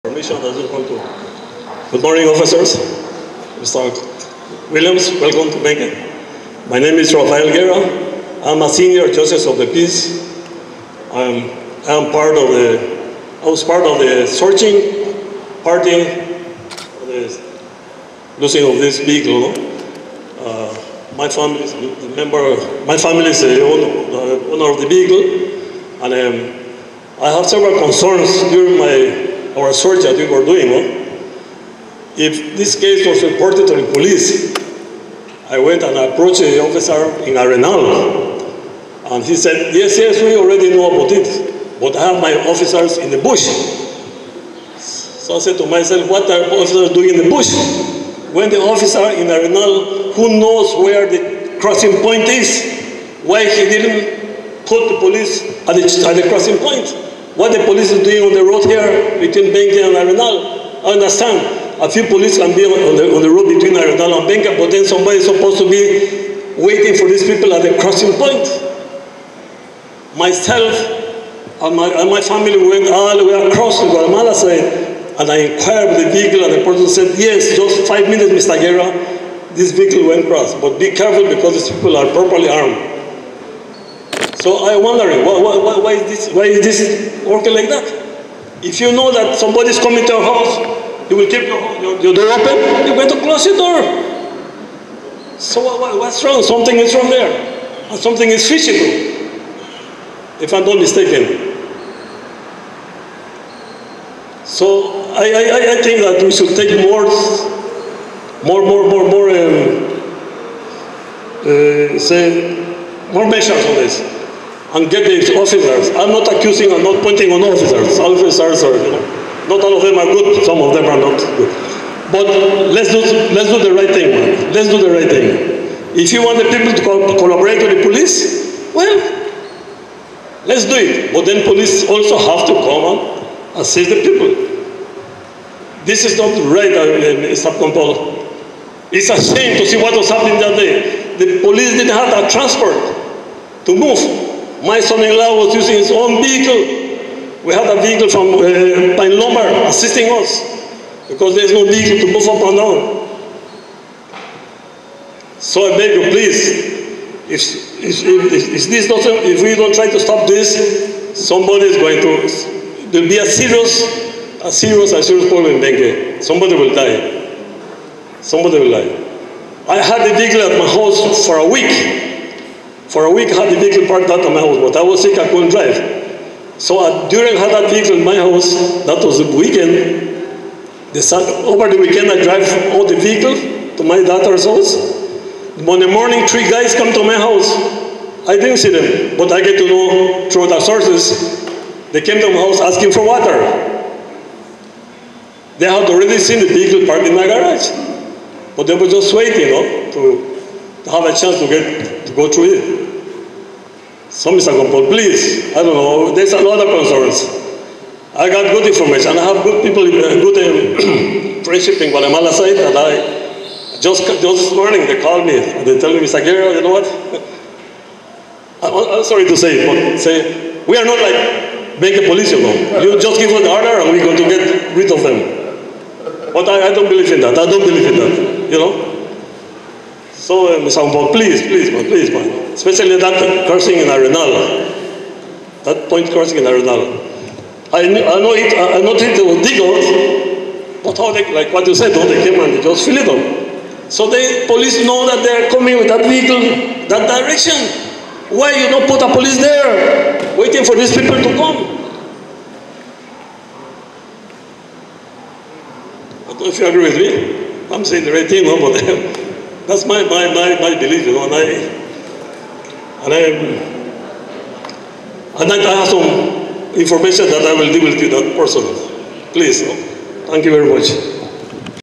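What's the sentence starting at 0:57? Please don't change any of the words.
What the police is doing on the road here between Benque and Arenal, I understand.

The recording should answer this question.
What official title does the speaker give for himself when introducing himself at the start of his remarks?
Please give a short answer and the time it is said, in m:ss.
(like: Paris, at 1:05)
Senior justice of the peace, at 0:08.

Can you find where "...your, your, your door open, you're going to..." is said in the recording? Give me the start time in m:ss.
1:31.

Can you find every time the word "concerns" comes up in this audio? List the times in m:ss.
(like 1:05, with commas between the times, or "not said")
0:27, 3:26.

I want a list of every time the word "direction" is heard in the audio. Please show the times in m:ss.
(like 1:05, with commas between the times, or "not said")
4:07.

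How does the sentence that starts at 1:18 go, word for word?
Guerra, this vehicle went across, but be careful because these people are properly armed.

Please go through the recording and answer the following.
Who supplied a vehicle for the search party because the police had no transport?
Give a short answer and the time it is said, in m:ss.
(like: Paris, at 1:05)
Pine, at 2:28.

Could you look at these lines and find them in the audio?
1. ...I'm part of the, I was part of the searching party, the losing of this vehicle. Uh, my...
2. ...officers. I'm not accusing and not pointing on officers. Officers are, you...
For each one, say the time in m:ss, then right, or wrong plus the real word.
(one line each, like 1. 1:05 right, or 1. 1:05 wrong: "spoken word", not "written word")
1. 0:11 right
2. 1:55 right.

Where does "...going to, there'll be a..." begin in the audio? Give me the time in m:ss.
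2:41.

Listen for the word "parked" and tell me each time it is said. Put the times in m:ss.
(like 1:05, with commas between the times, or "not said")
2:53, 3:16.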